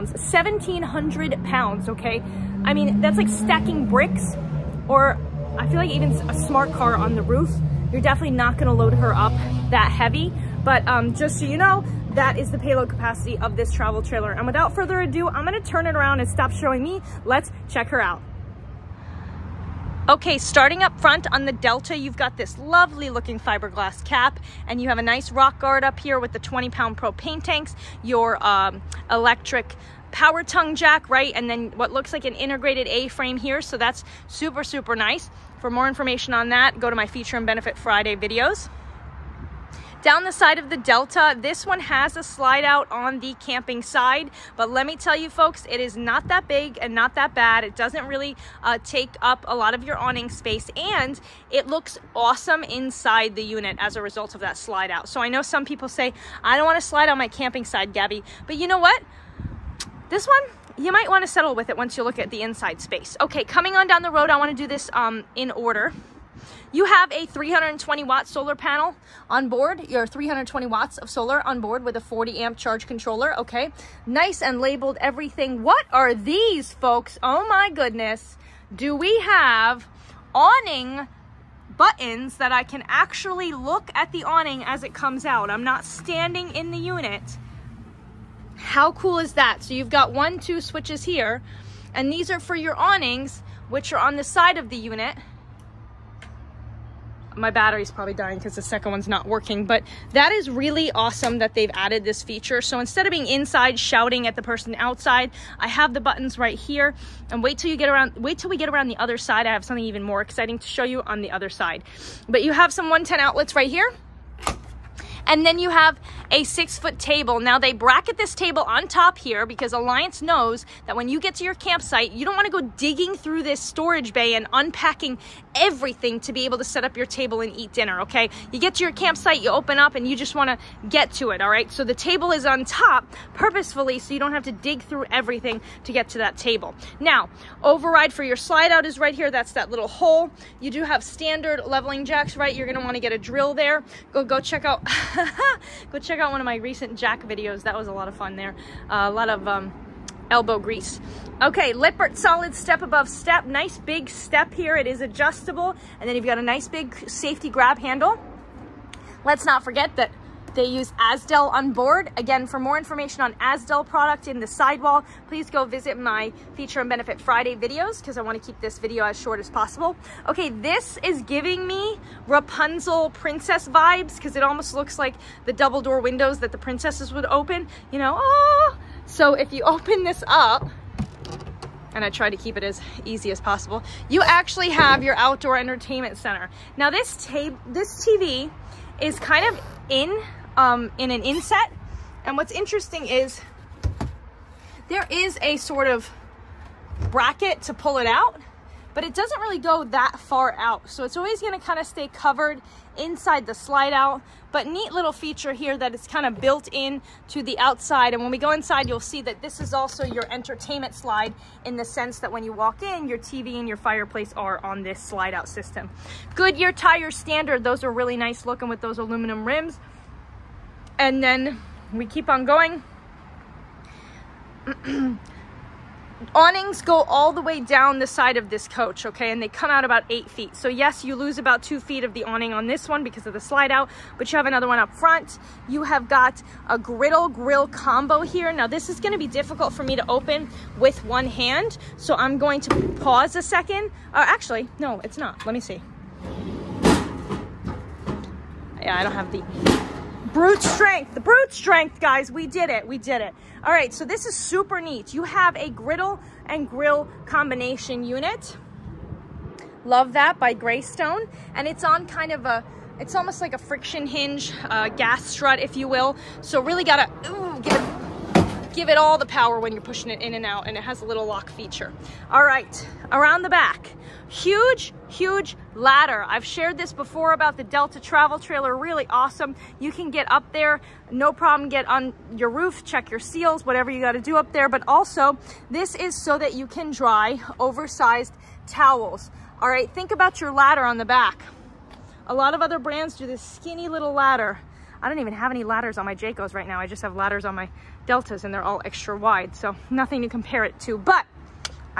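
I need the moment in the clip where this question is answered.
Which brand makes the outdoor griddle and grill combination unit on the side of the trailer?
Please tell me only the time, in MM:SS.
04:20.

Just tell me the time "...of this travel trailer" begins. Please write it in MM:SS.
00:13.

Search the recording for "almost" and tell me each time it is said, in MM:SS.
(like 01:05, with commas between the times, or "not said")
02:54, 04:23.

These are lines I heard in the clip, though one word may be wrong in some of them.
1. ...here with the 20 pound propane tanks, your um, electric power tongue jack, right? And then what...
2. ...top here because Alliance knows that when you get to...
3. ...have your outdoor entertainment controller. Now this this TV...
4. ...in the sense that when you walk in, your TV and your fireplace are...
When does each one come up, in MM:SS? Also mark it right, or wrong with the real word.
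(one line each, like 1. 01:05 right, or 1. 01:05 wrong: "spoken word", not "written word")
1. 00:25 right
2. 01:58 right
3. 03:04 wrong: "center", not "controller"
4. 03:31 right.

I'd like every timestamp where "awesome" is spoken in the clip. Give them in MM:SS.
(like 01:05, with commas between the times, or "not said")
00:52, 01:40, 04:39.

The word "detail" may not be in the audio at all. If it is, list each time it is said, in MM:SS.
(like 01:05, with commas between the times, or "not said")
not said.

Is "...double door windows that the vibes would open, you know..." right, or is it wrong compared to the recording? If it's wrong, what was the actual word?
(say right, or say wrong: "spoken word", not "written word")
wrong: "princesses", not "vibes".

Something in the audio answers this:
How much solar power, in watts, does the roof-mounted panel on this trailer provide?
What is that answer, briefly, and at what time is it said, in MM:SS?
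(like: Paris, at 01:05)
320 watts, at 01:07.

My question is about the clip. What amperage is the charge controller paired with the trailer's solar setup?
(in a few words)
40 amp.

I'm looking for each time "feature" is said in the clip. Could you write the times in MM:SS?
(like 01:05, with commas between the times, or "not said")
00:37, 01:42, 02:46, 03:25, 04:31.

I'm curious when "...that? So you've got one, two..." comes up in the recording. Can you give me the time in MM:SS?
01:29.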